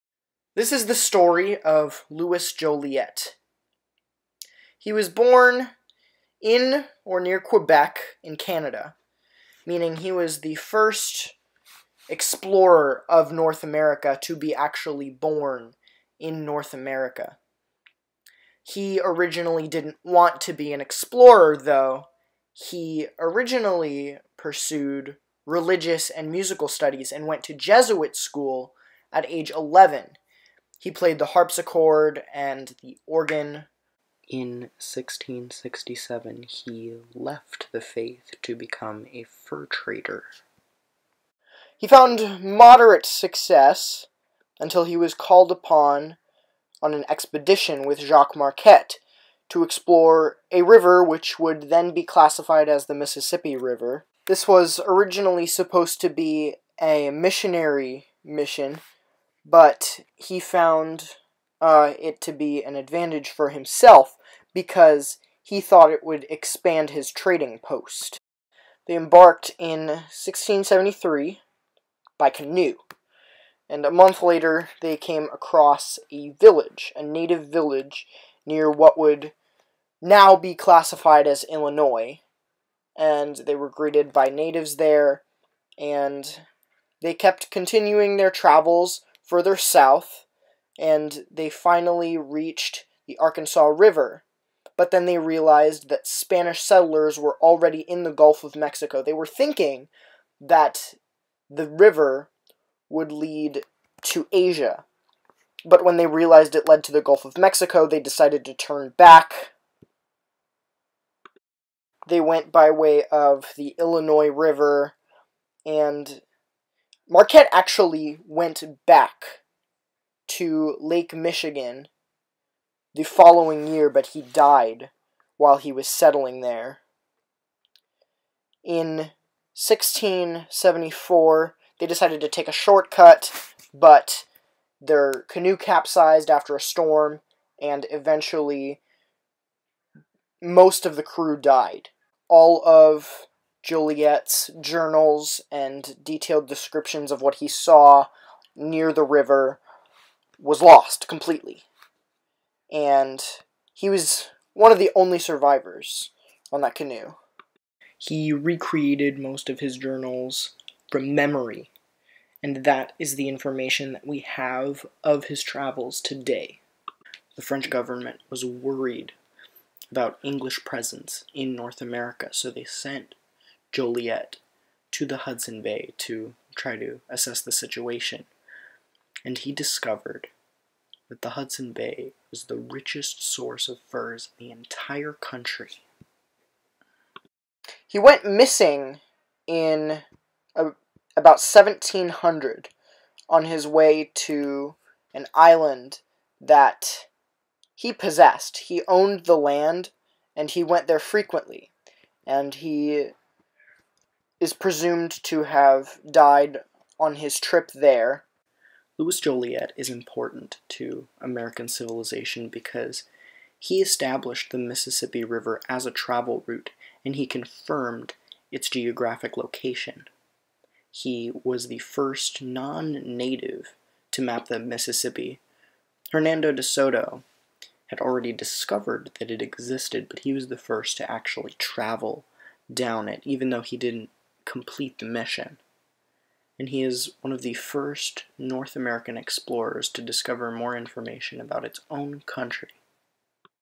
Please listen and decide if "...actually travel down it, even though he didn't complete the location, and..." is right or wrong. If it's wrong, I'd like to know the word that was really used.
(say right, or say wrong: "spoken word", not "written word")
wrong: "mission", not "location".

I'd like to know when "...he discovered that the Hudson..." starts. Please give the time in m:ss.
2:59.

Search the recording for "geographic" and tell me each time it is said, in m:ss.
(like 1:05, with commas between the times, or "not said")
3:38.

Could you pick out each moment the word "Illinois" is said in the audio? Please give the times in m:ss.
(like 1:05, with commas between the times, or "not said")
1:21, 1:53.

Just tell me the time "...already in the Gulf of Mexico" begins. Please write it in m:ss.
1:37.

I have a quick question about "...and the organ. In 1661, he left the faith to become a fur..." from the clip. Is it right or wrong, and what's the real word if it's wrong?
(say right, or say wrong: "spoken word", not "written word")
wrong: "1667", not "1661".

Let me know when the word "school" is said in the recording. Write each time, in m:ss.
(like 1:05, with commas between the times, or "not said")
0:28.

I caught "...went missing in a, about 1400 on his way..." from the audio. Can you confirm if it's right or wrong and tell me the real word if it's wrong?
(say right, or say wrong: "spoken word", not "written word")
wrong: "1700", not "1400".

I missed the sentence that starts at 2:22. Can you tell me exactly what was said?
All of Joliet's journals and detailed descriptions of what he saw near the river was lost completely.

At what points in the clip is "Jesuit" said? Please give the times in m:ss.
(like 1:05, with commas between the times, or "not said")
0:27.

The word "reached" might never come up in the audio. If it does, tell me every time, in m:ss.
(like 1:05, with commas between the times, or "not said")
1:32.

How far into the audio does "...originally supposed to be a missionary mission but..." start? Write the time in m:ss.
0:54.